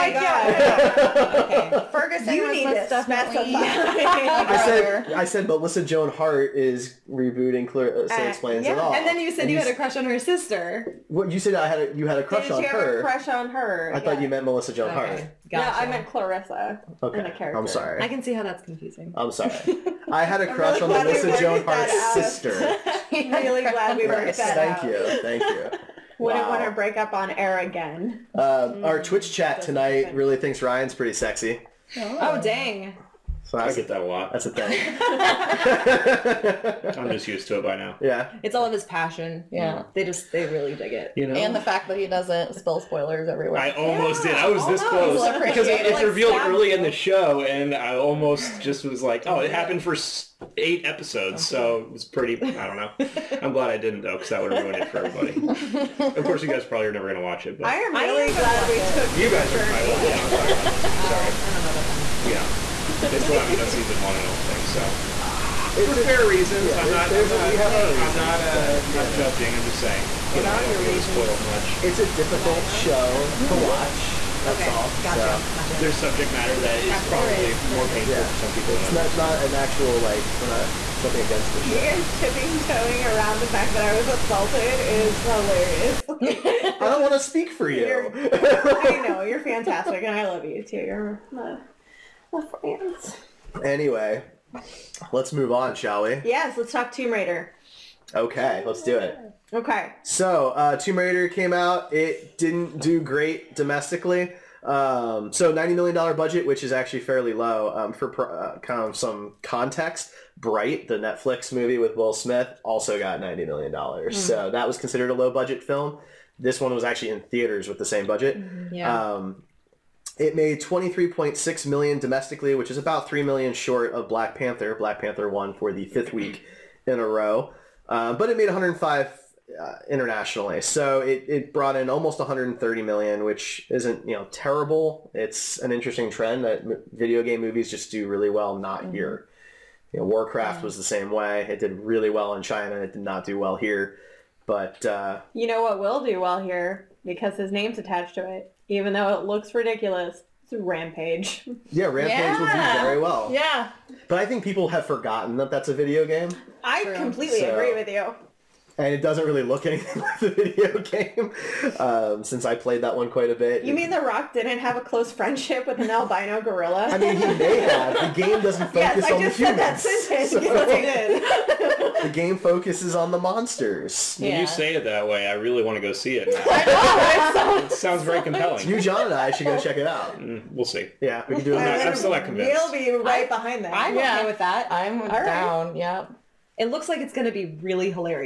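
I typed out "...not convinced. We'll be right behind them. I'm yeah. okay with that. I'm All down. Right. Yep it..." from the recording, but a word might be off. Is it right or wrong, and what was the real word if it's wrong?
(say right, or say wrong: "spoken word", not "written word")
right.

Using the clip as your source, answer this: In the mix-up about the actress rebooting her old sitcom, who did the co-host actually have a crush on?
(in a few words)
Melissa Joan Hart's sister.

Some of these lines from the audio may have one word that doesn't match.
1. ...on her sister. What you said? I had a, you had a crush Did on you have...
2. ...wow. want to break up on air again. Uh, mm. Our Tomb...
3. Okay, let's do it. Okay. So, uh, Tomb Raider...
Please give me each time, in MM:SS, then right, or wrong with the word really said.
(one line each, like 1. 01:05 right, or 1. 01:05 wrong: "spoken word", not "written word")
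1. 00:09 right
2. 00:26 wrong: "Twitch", not "Tomb"
3. 01:38 right.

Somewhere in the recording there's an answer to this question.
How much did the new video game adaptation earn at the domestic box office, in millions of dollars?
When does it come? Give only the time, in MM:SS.
02:00.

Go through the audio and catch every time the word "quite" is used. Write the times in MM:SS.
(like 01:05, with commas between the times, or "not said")
02:43.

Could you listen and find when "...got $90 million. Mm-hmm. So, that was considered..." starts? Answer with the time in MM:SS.
01:52.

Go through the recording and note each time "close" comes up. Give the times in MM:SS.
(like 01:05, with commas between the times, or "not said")
00:45, 02:44.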